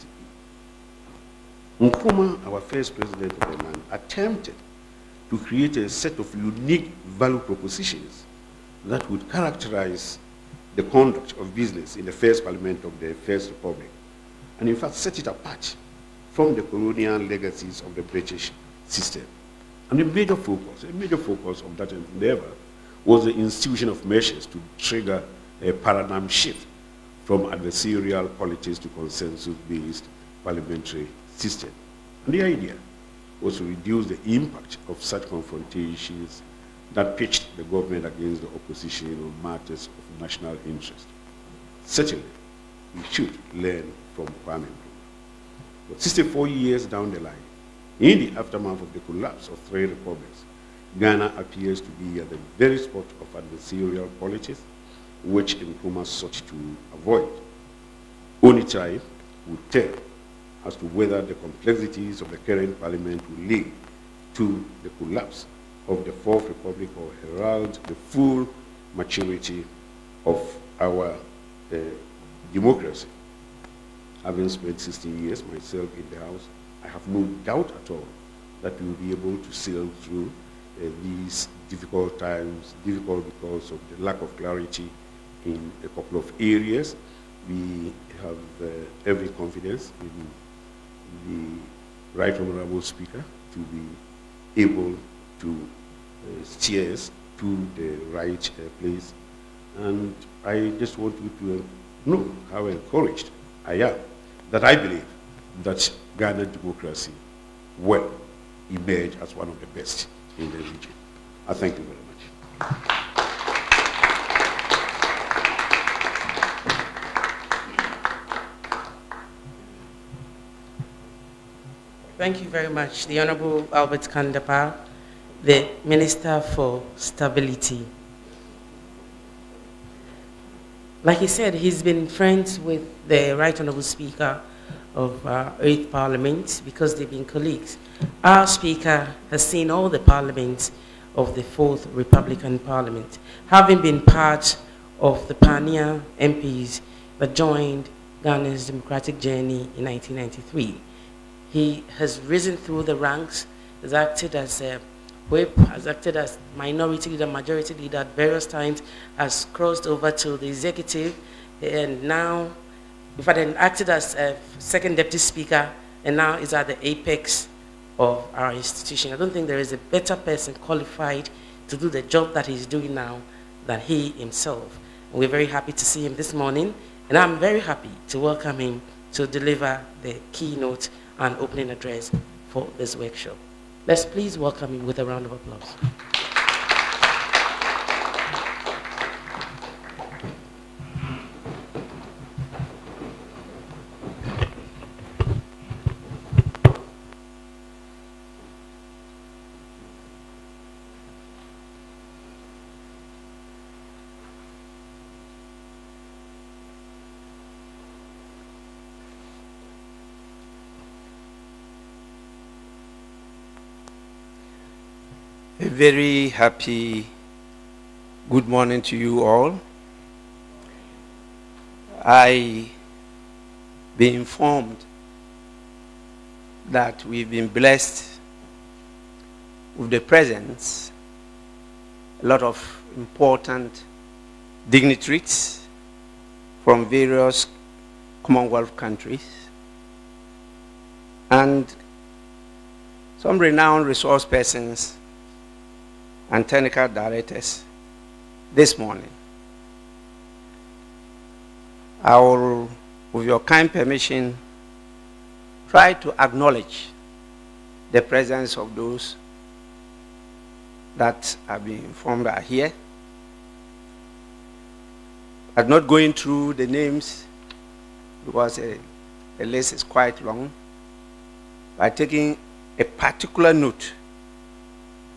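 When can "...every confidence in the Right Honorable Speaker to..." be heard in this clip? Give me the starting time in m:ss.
1:29.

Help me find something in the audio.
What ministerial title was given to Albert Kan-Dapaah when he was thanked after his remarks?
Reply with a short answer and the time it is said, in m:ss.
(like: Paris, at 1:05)
Minister for Stability, at 2:05.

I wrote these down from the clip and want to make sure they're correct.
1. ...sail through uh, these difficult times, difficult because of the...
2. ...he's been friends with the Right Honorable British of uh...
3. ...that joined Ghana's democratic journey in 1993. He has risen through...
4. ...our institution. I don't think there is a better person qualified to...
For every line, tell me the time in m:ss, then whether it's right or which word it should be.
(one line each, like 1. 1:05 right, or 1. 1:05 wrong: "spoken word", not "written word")
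1. 1:19 right
2. 2:11 wrong: "Speaker", not "British"
3. 2:27 right
4. 2:48 right.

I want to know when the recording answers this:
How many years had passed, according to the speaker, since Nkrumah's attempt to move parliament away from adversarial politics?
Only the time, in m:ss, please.
0:46.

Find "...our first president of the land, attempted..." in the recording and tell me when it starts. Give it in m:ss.
0:02.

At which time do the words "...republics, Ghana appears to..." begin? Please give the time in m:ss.
0:49.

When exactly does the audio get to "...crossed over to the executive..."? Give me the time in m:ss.
2:39.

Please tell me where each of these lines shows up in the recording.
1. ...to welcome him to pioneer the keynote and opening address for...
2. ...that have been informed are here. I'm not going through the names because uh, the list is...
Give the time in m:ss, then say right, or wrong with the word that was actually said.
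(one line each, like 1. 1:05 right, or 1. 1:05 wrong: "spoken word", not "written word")
1. 2:58 wrong: "deliver", not "pioneer"
2. 4:20 right.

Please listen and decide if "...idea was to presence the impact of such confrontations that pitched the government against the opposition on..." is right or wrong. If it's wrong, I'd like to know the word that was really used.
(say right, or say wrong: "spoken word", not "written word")
wrong: "reduce", not "presence".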